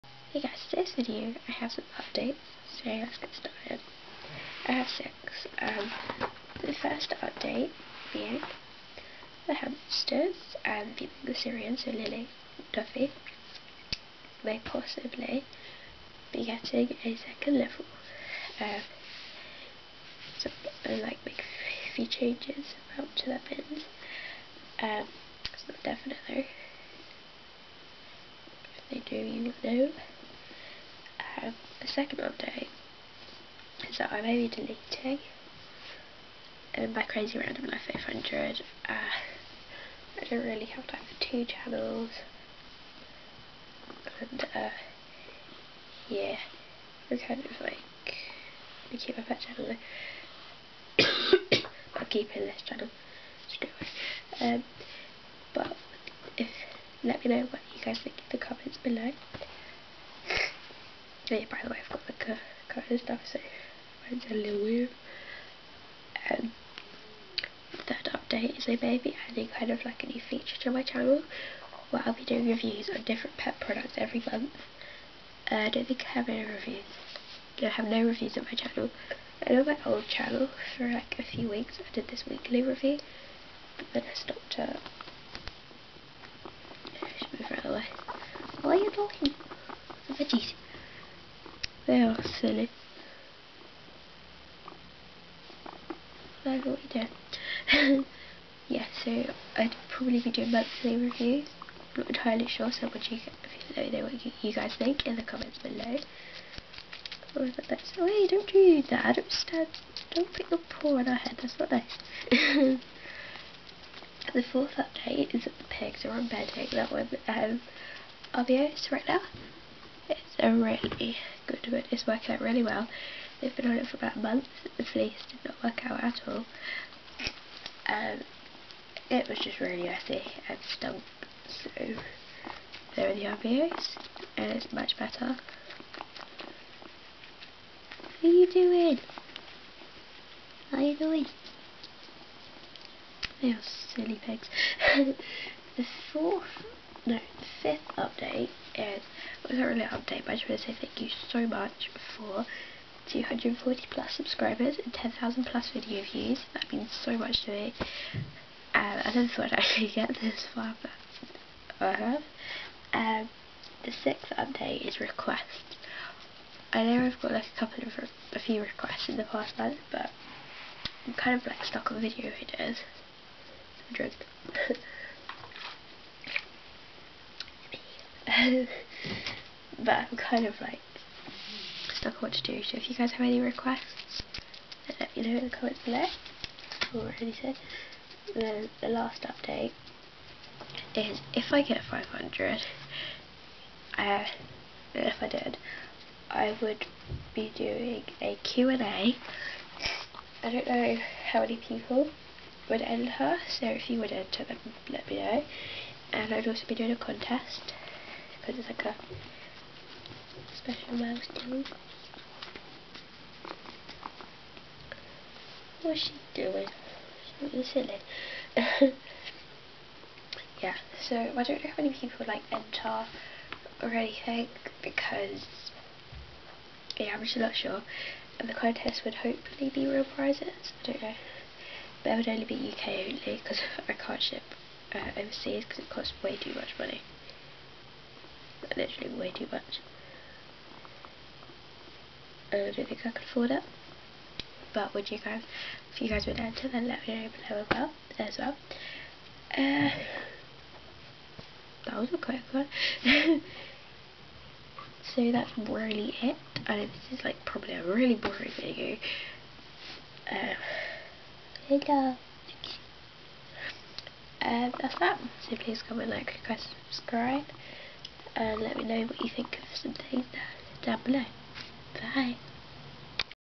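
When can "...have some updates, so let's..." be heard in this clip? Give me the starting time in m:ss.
0:01.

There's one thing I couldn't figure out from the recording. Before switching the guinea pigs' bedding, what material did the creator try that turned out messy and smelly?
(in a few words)
Fleece.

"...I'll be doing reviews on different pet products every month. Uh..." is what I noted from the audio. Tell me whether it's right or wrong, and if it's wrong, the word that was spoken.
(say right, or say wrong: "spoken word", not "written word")
right.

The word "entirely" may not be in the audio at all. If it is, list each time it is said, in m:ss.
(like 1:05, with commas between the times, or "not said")
1:42.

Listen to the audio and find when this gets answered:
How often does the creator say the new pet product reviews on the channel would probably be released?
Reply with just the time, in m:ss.
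1:40.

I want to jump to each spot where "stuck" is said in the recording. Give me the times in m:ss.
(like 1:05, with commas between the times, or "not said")
2:51, 3:01.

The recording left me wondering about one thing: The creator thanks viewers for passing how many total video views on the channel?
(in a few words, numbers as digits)
10,000.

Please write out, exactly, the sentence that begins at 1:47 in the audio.
Oh, that's Oh hey, don't do that.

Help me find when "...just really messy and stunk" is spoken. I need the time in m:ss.
2:09.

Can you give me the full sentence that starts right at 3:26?
And I'd also be doing a contest because it's like a special mouse, milestone.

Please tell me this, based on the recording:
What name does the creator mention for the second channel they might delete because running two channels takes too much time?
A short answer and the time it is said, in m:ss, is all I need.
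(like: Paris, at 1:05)
Crazy Random Life 500, at 0:37.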